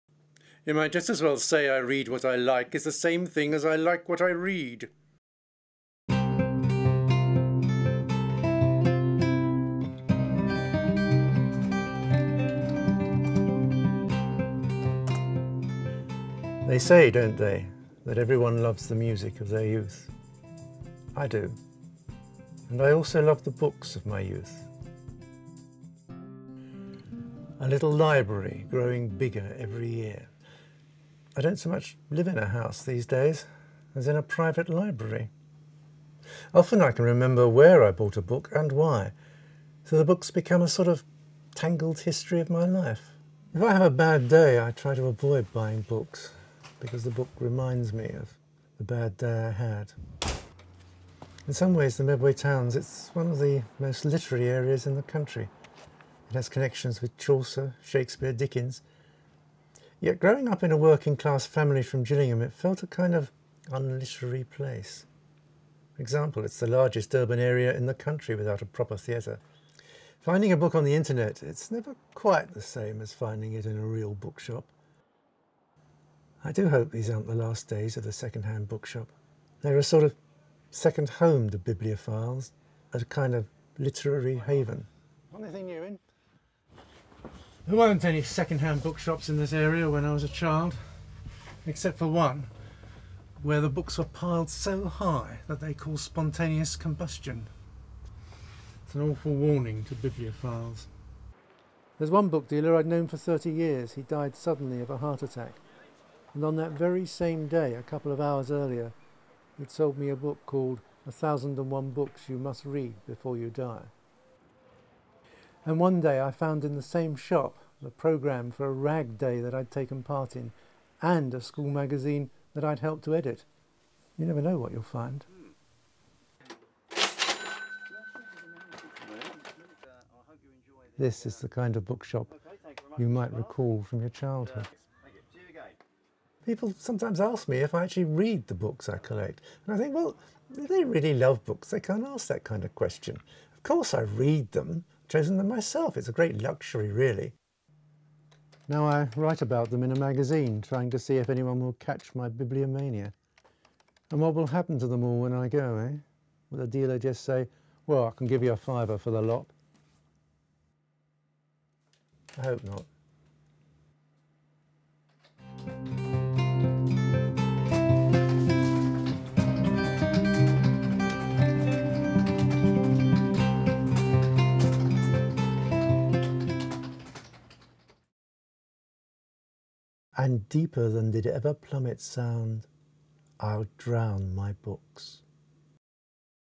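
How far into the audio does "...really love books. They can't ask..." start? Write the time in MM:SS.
02:20.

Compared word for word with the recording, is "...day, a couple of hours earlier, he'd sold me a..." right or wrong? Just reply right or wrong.
right.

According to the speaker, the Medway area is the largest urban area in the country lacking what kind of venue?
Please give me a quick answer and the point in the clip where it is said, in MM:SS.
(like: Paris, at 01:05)
a proper theatre, at 01:08.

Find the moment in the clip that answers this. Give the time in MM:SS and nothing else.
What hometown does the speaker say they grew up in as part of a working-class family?
01:02.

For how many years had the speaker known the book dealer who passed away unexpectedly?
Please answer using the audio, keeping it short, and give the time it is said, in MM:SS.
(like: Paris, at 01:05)
30, at 01:43.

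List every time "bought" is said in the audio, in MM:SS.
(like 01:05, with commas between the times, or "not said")
00:37.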